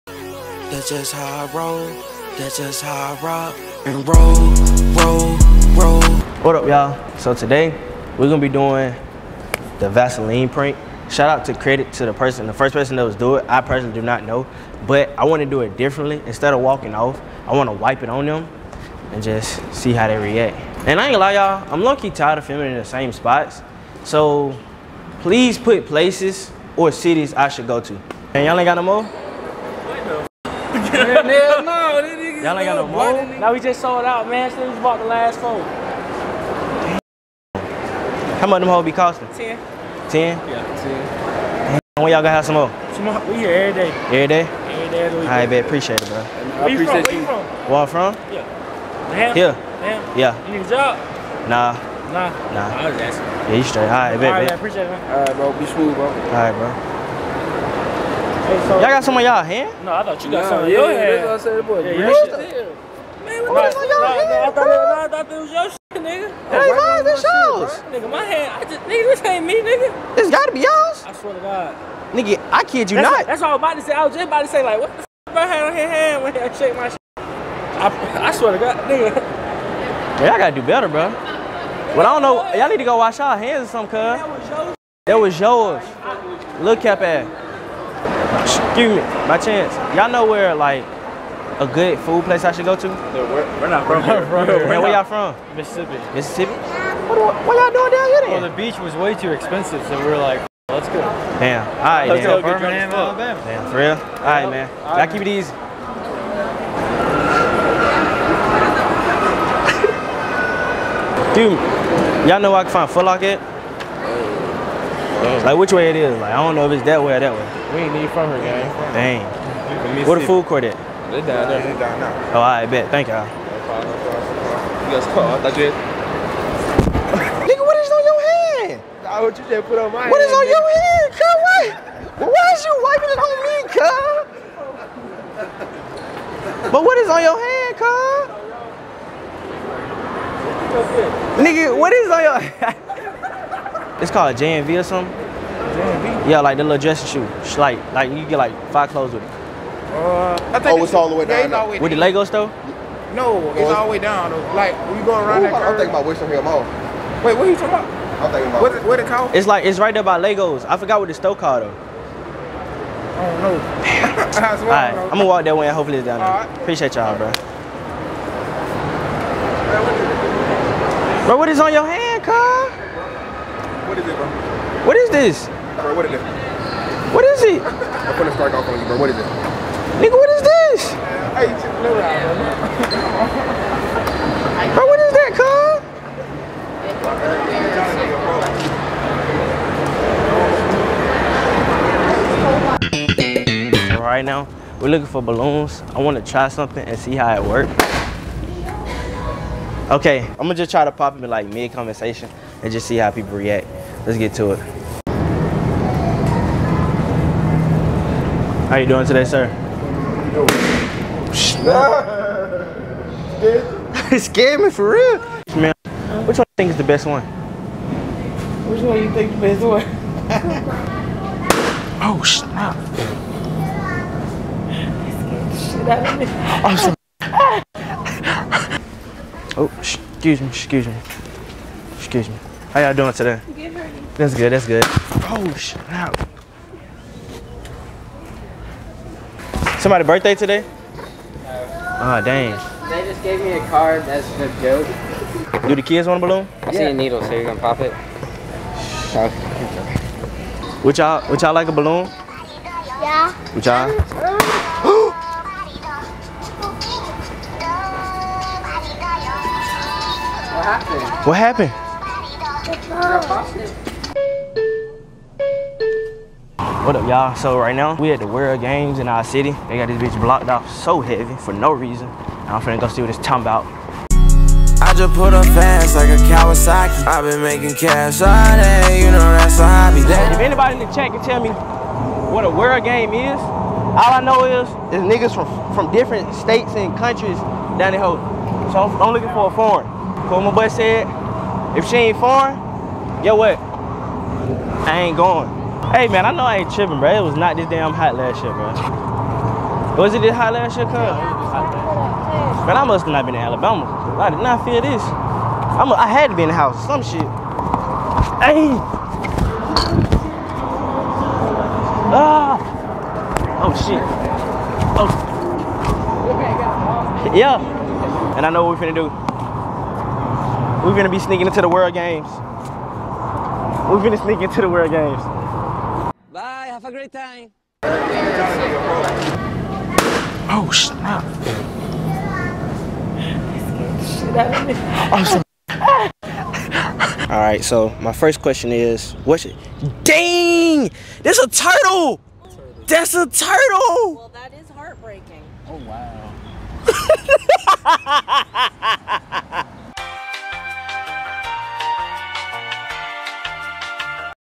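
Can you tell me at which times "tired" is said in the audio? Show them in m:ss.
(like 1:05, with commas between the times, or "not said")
0:22.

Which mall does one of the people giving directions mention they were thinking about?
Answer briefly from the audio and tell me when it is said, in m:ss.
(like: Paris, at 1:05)
Western Hill Mall, at 2:36.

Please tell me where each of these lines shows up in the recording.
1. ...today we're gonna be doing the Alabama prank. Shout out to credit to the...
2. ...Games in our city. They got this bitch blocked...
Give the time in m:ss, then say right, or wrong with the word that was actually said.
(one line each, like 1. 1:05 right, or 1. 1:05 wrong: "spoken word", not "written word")
1. 0:07 wrong: "Vaseline", not "Alabama"
2. 4:28 right.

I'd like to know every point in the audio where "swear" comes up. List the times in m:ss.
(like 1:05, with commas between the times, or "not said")
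1:11, 1:18.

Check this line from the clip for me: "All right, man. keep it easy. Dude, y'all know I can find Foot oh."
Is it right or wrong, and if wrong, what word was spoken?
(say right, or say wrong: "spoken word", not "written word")
right.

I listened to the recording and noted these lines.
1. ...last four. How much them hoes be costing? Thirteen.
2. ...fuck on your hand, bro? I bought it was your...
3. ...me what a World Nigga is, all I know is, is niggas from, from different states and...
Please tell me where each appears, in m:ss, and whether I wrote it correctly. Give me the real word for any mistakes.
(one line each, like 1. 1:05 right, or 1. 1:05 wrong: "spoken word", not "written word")
1. 0:35 wrong: "Ten", not "Thirteen"
2. 1:03 wrong: "thought", not "bought"
3. 4:41 wrong: "Game", not "Nigga".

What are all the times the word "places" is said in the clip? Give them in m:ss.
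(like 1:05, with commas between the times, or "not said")
0:25, 1:32.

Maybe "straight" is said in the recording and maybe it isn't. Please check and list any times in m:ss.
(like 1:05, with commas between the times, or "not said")
0:53.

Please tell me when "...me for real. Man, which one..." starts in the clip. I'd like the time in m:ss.
3:34.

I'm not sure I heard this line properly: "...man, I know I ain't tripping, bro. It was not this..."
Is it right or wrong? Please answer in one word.
right.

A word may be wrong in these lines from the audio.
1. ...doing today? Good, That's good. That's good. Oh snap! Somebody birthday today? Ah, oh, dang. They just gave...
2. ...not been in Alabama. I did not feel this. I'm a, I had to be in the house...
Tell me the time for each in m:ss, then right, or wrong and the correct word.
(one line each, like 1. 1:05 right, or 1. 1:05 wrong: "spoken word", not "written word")
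1. 3:52 right
2. 5:03 right.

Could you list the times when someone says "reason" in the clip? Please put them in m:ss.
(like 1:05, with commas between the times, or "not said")
4:31.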